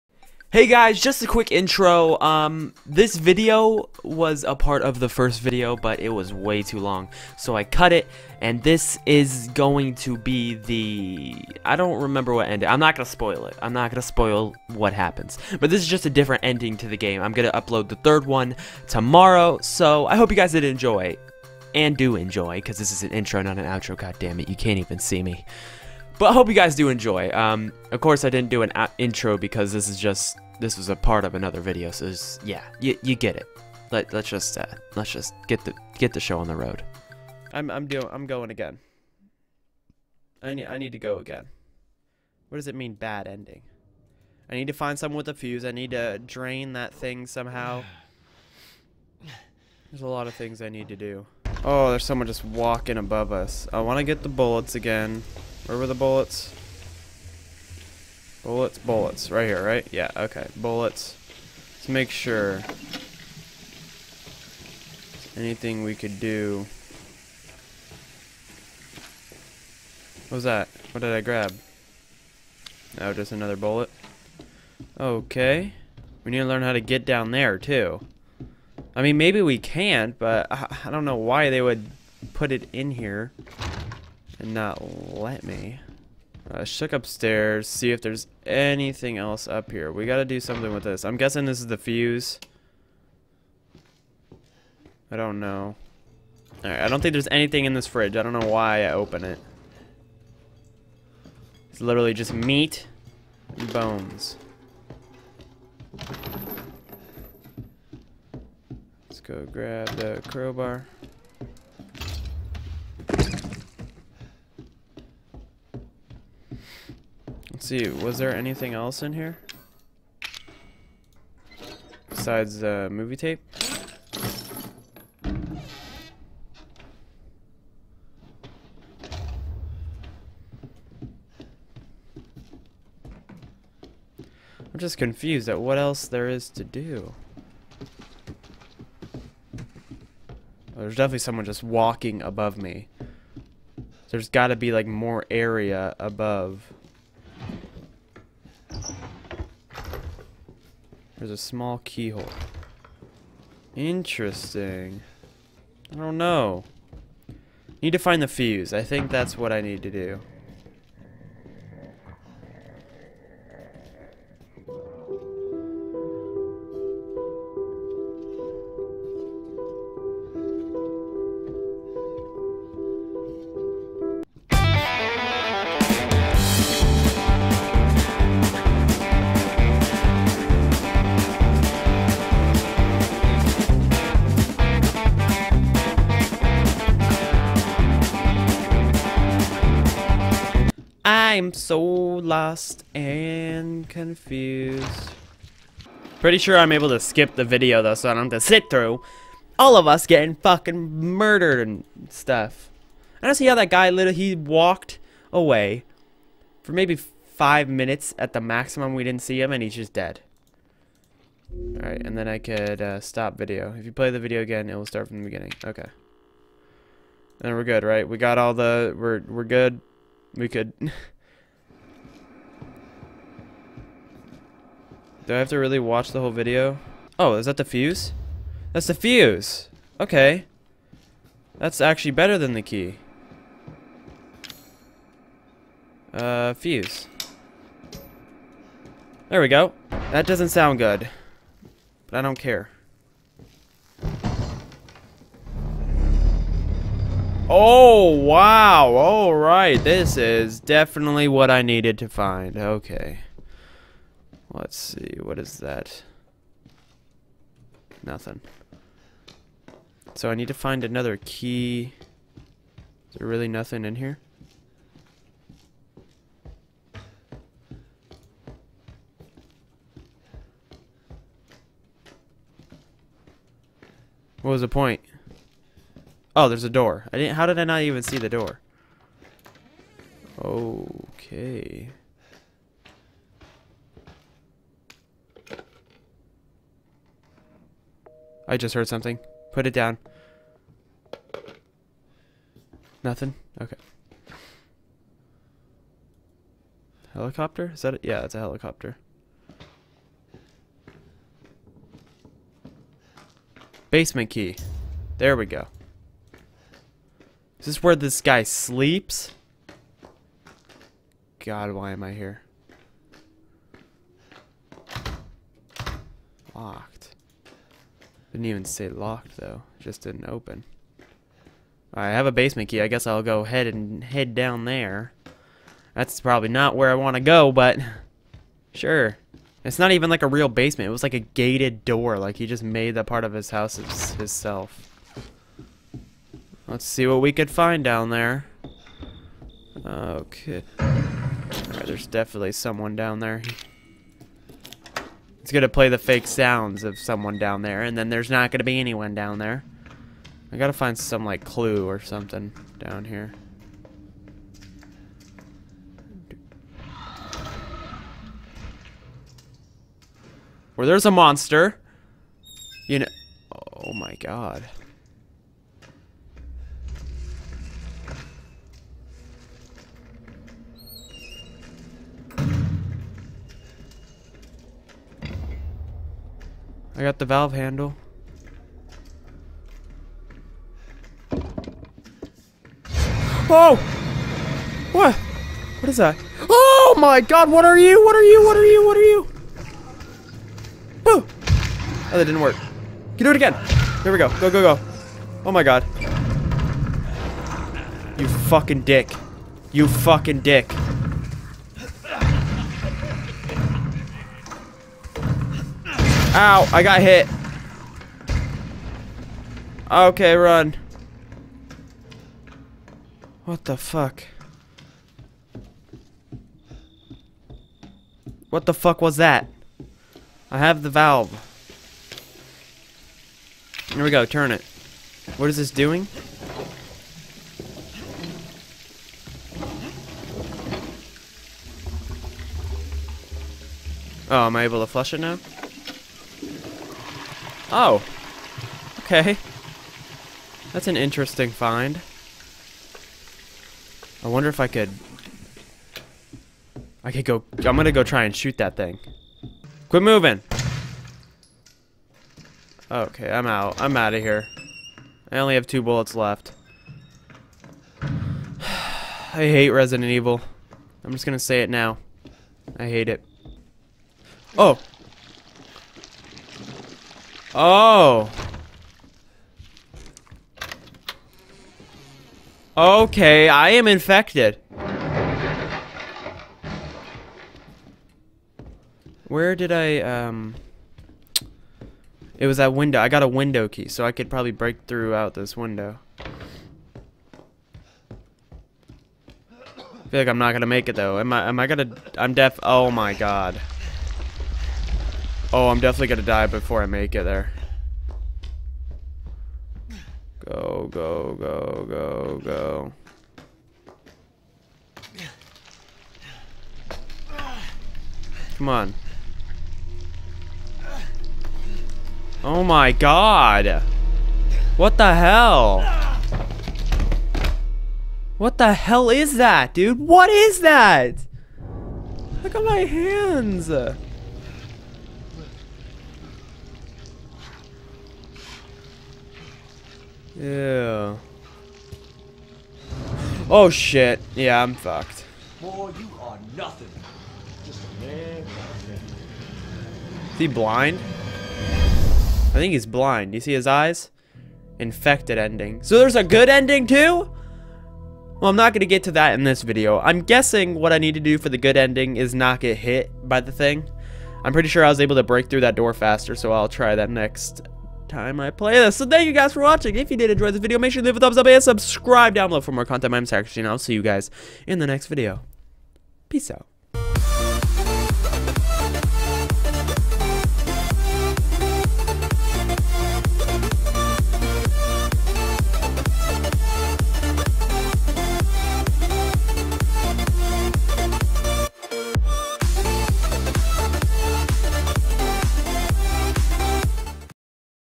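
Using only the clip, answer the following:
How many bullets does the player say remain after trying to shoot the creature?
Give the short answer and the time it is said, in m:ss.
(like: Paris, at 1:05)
2, at 7:35.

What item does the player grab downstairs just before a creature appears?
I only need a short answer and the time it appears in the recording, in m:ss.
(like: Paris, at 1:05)
valve handle, at 6:17.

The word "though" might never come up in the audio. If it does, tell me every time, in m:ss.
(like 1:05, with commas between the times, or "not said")
3:17, 5:19, 8:10.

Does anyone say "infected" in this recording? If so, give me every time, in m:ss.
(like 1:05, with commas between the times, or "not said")
7:53, 9:04.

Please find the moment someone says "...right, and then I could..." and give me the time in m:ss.
3:31.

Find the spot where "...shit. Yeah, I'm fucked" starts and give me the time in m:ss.
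8:53.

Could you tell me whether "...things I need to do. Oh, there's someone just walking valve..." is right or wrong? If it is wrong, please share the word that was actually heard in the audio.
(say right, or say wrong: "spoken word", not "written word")
wrong: "above", not "valve".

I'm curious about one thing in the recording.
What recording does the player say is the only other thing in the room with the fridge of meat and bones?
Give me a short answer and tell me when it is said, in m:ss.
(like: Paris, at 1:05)
movie tape, at 2:02.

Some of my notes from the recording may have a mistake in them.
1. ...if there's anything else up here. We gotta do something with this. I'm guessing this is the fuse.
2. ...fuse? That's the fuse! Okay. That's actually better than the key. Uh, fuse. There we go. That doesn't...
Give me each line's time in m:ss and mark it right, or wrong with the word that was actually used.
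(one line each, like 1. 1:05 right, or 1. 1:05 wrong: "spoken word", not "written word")
1. 1:27 right
2. 3:47 right.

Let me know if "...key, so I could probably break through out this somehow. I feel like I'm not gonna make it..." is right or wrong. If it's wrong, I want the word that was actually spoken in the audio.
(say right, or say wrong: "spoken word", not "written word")
wrong: "window", not "somehow".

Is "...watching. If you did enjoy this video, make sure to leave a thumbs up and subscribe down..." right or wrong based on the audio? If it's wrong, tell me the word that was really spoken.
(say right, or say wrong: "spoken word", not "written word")
right.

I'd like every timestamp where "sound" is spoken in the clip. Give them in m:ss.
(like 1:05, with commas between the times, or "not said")
4:00, 5:46.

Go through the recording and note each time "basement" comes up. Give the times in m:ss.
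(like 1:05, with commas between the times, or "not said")
5:03, 5:22, 5:30.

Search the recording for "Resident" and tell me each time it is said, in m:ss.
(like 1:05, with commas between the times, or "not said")
7:39.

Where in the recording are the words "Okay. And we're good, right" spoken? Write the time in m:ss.
3:35.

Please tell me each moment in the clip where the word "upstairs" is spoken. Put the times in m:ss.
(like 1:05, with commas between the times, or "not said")
1:26.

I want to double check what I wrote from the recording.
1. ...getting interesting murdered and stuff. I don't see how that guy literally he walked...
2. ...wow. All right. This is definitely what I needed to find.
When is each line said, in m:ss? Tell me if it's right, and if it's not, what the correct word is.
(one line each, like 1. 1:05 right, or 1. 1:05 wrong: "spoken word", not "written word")
1. 3:20 wrong: "fucking", not "interesting"
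2. 4:08 right.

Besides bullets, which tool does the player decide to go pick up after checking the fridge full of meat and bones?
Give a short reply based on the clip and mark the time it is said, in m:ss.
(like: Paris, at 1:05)
crowbar, at 1:50.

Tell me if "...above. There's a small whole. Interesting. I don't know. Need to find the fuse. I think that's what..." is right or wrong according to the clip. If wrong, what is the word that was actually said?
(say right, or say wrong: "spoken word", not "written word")
wrong: "keyhole", not "whole".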